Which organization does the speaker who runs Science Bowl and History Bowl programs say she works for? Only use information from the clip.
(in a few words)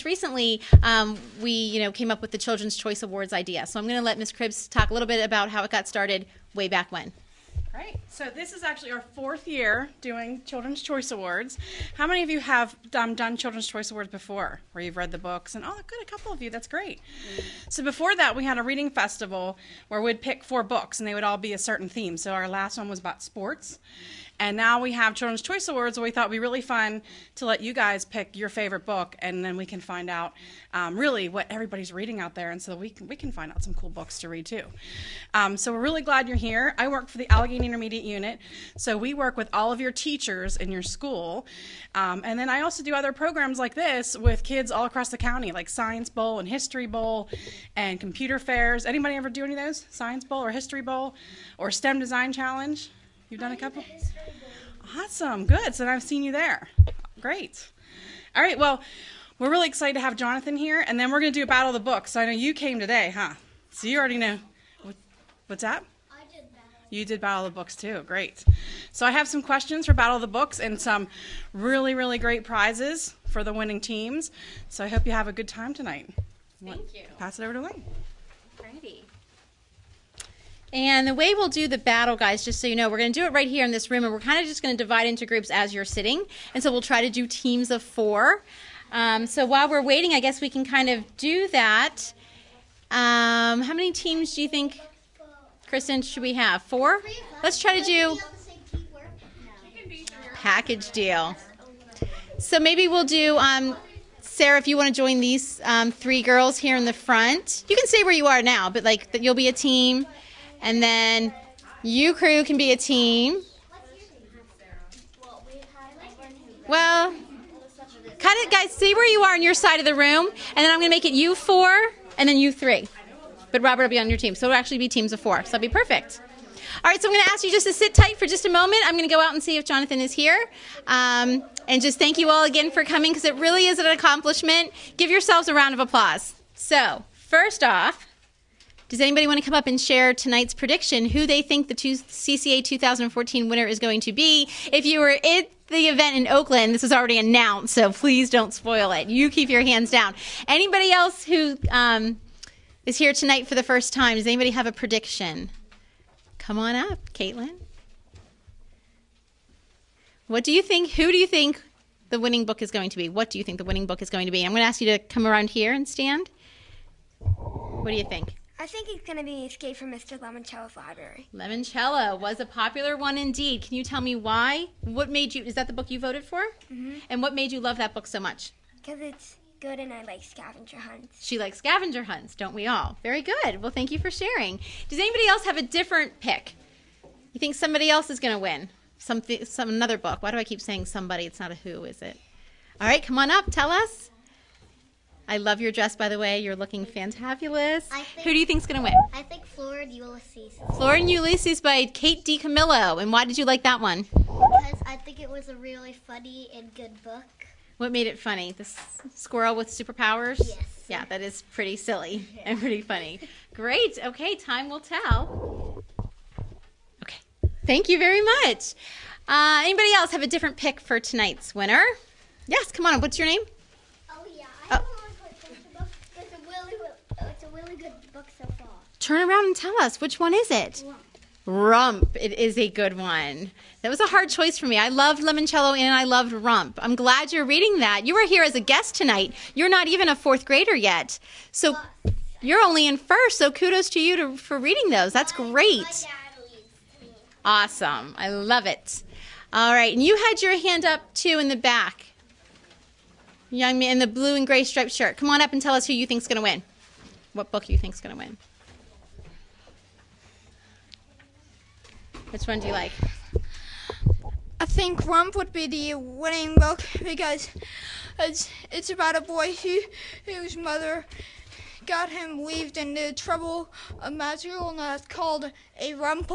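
Allegheny Intermediate Unit.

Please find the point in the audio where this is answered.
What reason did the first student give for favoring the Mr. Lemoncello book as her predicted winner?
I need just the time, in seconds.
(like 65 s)
179 s.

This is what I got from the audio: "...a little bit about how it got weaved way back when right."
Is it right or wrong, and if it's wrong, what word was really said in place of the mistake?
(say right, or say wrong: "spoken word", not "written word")
wrong: "started", not "weaved".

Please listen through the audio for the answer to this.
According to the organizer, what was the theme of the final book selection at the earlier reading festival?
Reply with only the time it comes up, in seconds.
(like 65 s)
23 s.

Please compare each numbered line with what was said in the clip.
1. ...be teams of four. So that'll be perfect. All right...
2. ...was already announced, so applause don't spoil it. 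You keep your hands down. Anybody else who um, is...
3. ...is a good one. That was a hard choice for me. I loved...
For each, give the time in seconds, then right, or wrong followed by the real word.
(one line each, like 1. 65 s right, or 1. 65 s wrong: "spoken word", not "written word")
1. 124 s right
2. 146 s wrong: "please", not "applause"
3. 232 s right.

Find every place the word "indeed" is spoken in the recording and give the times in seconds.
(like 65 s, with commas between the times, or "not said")
173 s.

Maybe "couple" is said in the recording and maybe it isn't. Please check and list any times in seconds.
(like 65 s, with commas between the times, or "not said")
16 s, 53 s.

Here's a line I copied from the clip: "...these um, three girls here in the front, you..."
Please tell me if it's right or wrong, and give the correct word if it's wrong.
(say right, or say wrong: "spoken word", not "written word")
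right.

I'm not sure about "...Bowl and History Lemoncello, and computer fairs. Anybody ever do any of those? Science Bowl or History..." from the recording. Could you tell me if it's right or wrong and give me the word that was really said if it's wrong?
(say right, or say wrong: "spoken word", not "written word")
wrong: "Bowl", not "Lemoncello".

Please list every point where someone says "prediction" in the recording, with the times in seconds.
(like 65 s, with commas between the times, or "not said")
140 s, 154 s.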